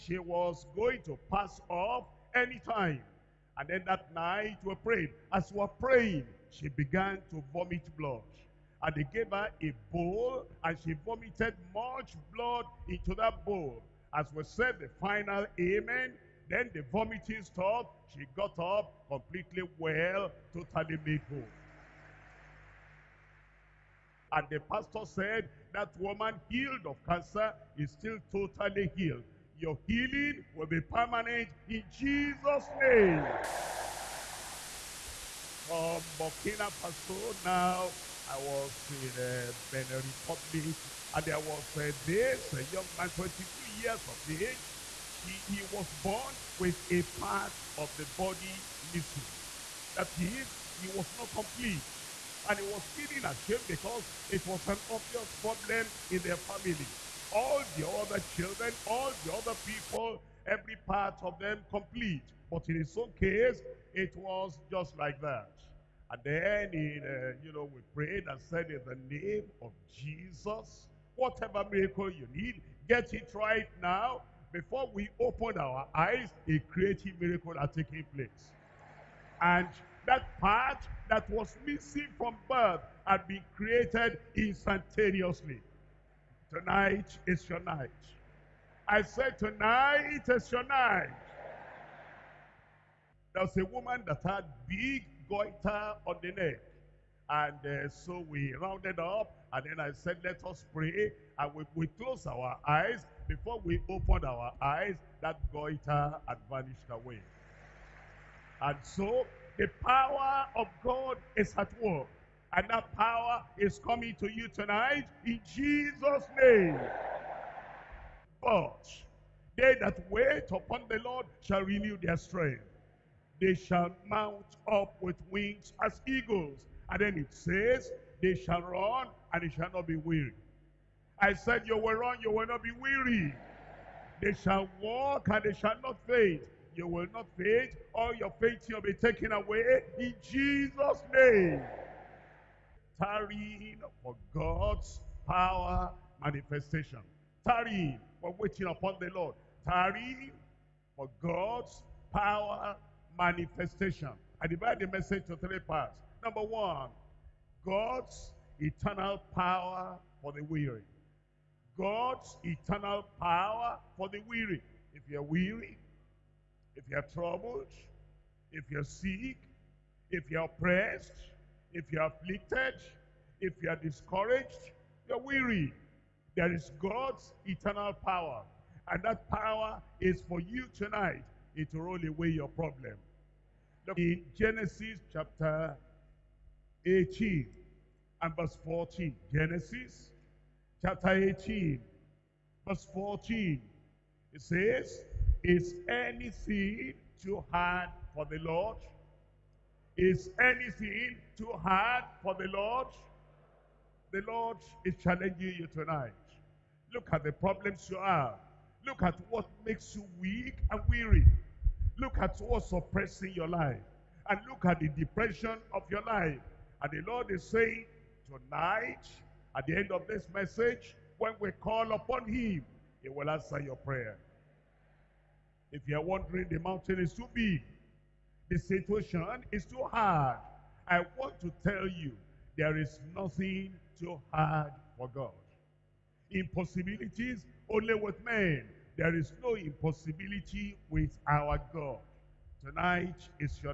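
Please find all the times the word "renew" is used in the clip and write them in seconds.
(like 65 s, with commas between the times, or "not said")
121 s.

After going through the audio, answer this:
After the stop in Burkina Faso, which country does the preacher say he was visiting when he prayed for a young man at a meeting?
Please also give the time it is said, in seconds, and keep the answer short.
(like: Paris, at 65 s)
Benin Republic, at 39 s.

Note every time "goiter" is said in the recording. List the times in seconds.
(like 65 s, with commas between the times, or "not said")
95 s, 105 s.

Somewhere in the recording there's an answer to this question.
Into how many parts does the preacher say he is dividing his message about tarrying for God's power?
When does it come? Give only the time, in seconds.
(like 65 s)
155 s.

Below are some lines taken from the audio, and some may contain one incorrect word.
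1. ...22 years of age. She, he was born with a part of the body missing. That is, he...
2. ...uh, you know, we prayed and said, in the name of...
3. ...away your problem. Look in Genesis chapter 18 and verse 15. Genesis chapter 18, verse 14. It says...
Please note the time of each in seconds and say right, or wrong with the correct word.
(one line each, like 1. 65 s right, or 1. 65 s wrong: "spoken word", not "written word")
1. 43 s right
2. 67 s right
3. 182 s wrong: "14", not "15".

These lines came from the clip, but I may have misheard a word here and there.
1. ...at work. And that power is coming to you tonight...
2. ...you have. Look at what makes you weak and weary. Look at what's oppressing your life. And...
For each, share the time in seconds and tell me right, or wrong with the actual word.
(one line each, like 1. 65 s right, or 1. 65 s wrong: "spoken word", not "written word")
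1. 111 s right
2. 207 s right.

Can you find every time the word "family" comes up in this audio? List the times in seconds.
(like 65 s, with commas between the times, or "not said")
56 s.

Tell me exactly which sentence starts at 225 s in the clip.
If you are wondering, the mountain is too big.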